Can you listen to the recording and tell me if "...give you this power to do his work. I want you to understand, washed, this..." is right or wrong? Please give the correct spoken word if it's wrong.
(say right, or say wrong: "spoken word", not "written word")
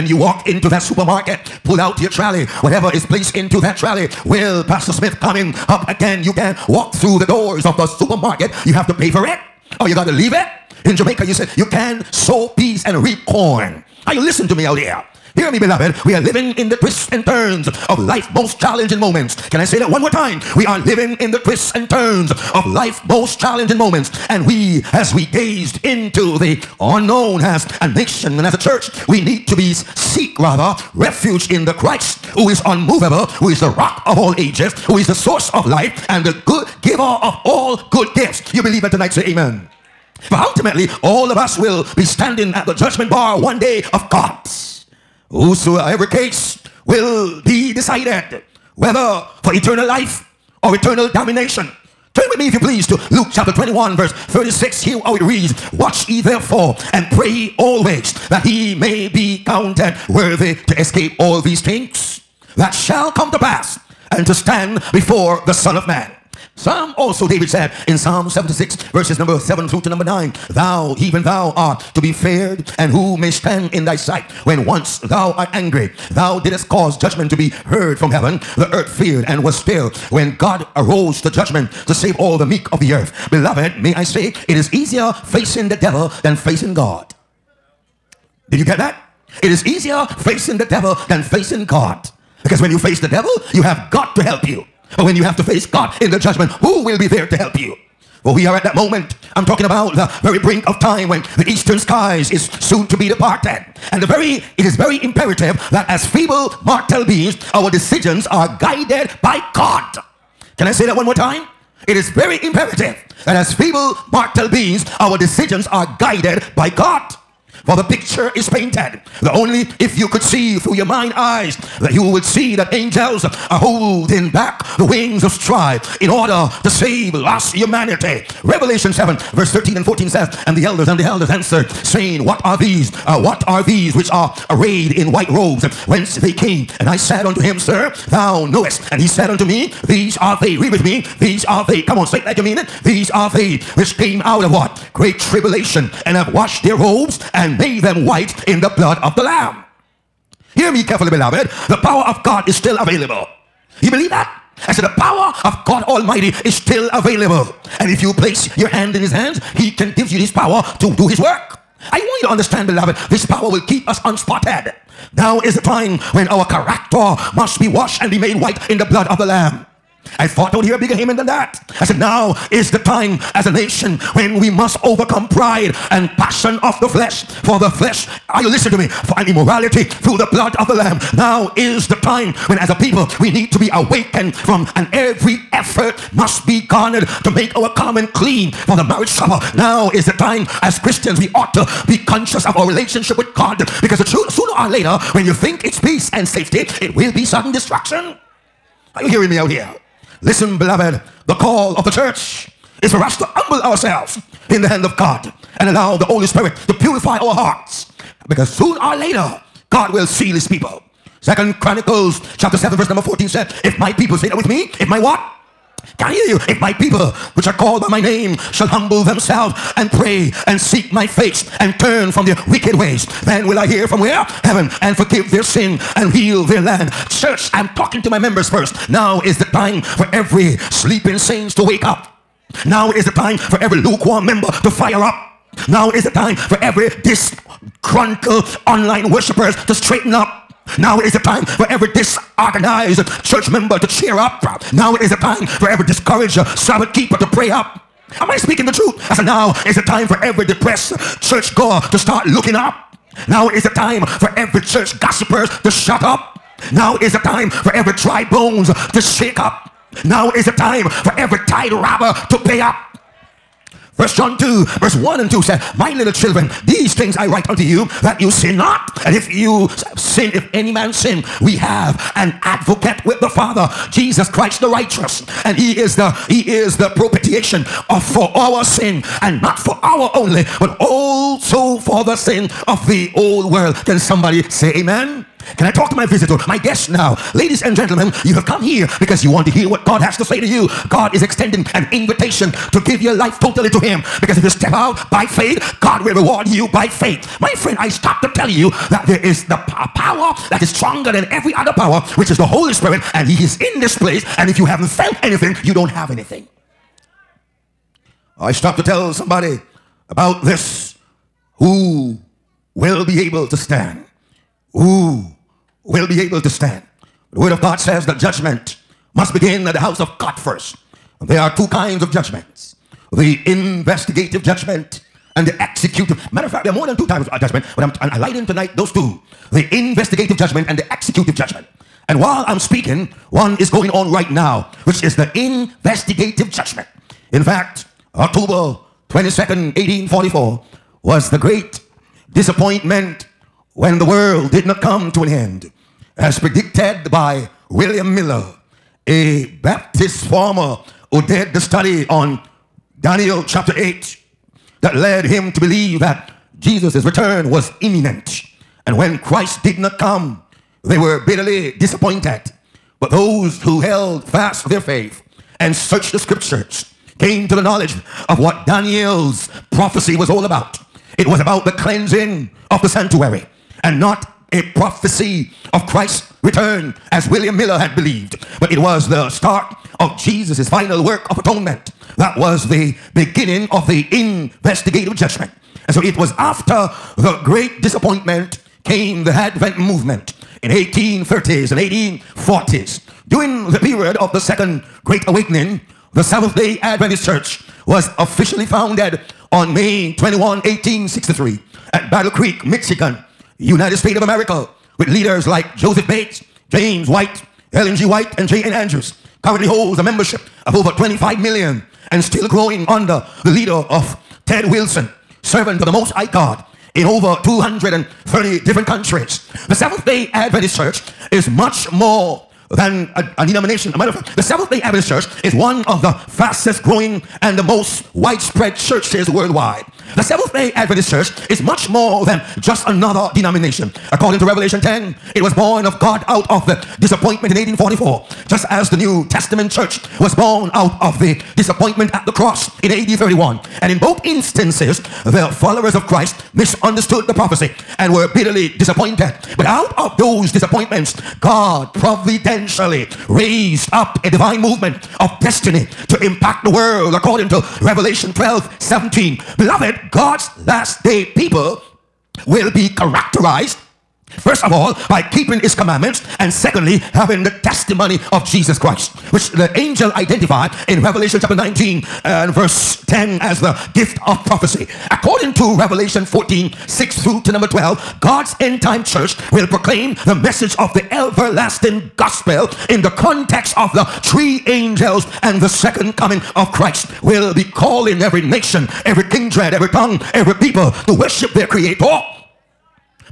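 wrong: "beloved", not "washed".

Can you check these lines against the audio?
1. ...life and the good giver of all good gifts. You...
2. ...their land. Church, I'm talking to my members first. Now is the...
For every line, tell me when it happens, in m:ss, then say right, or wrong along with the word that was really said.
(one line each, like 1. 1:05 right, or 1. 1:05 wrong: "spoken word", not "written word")
1. 0:35 right
2. 3:46 right.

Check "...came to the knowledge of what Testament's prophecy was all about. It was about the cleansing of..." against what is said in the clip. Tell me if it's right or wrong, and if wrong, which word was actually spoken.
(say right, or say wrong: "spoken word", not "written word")
wrong: "Daniel", not "Testament".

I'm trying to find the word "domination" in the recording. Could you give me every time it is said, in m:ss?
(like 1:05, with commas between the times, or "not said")
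0:51.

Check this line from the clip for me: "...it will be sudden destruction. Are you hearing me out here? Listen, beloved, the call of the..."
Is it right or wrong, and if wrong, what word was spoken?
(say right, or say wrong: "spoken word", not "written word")
right.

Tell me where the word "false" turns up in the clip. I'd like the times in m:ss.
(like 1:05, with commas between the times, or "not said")
not said.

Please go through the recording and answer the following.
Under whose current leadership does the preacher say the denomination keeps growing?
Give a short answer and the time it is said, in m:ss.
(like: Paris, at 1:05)
Ted Wilson, at 6:54.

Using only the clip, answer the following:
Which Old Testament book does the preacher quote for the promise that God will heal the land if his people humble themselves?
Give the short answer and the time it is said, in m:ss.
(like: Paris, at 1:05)
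Second Chronicles, at 3:31.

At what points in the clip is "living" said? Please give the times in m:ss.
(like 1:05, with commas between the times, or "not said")
0:16, 0:20.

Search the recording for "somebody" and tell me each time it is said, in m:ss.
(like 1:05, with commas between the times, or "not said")
4:43, 5:09.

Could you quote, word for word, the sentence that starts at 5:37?
In fact, October 22nd, 1844 was the great disappointment when the world did not come to an end.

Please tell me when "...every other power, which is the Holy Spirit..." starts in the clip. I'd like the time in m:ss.
5:01.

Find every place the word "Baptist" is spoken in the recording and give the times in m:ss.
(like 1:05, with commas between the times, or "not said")
5:49.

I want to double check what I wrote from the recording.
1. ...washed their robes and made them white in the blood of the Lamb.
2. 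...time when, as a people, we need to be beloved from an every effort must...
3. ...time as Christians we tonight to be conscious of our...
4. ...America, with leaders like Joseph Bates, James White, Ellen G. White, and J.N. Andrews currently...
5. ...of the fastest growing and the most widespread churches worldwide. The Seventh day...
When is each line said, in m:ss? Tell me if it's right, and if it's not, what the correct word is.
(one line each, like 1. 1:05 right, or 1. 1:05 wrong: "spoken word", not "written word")
1. 2:26 right
2. 3:02 wrong: "awakened", not "beloved"
3. 3:10 wrong: "ought", not "tonight"
4. 6:44 right
5. 7:05 right.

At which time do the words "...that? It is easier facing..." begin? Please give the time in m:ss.
1:28.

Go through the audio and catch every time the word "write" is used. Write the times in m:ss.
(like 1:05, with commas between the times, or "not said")
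4:27.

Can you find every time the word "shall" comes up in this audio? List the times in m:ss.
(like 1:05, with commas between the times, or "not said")
1:02, 3:38.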